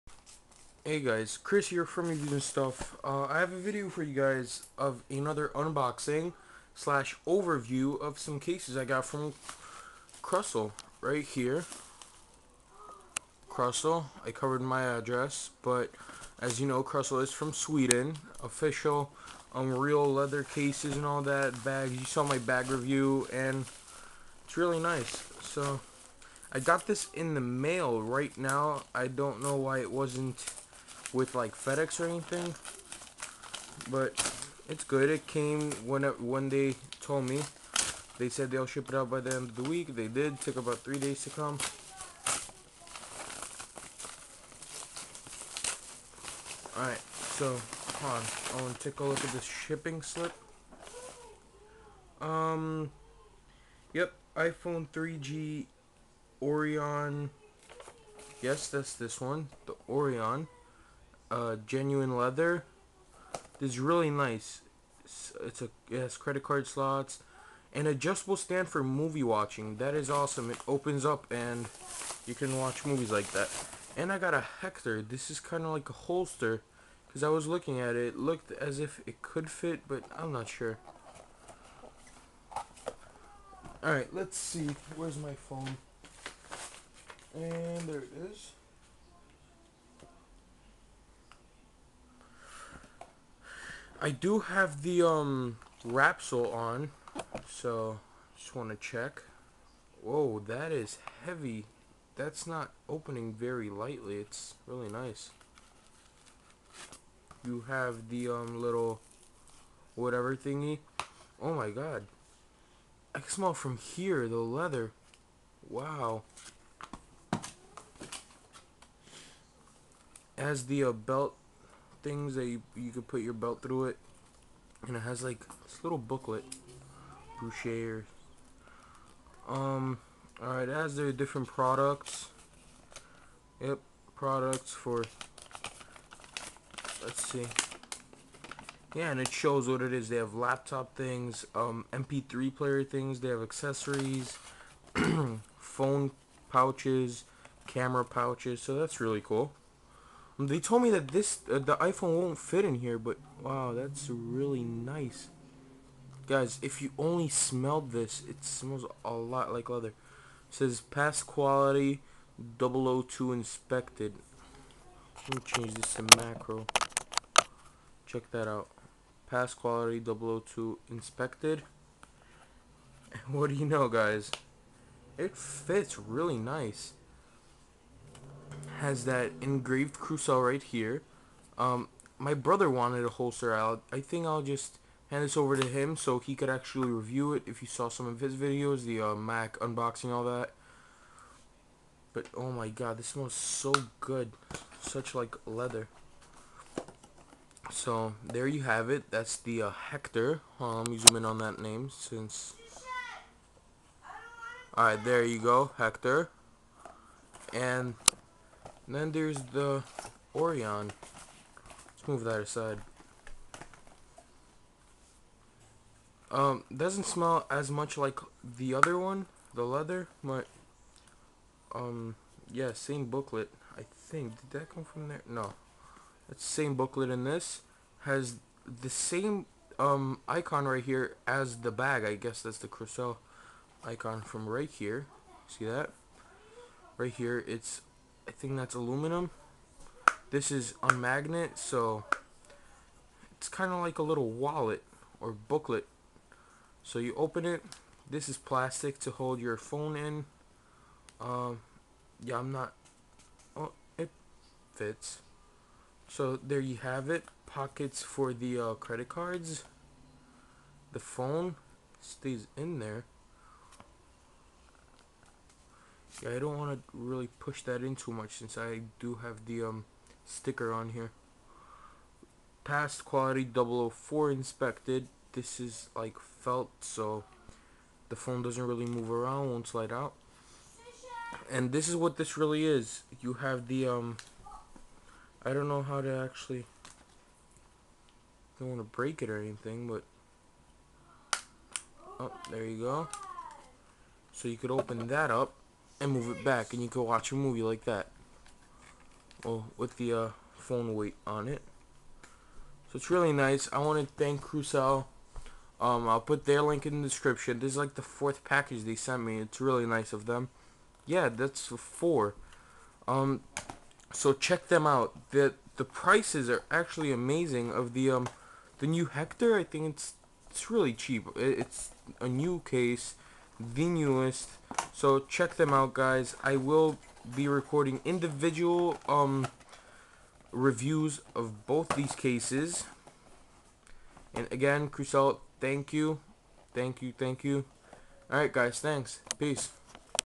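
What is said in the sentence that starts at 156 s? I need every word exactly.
Guys, if you only smelled this, it smells a lot like leather.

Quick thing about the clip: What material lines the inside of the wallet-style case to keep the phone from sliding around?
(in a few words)
Felt.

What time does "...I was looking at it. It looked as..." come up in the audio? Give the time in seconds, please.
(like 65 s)
77 s.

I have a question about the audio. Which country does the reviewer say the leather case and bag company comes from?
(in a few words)
Sweden.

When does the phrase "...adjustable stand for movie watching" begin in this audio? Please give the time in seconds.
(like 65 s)
67 s.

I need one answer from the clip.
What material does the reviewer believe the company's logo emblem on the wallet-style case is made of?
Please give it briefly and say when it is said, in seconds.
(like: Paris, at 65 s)
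Aluminum, at 238 s.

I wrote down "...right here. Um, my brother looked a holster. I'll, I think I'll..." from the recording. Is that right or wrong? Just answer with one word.
wrong.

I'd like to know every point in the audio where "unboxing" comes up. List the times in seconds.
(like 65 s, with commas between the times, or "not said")
5 s, 189 s.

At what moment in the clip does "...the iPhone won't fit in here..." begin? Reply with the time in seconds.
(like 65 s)
151 s.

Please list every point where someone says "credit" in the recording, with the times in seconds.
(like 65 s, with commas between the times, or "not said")
66 s, 258 s.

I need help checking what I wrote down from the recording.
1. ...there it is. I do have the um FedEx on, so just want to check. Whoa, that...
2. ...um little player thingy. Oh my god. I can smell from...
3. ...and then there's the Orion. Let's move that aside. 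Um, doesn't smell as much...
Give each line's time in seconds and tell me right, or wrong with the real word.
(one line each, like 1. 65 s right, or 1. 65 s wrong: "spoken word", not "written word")
1. 87 s wrong: "Rapsol", not "FedEx"
2. 108 s wrong: "whatever", not "player"
3. 208 s right.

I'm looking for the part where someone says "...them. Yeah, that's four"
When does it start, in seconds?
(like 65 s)
310 s.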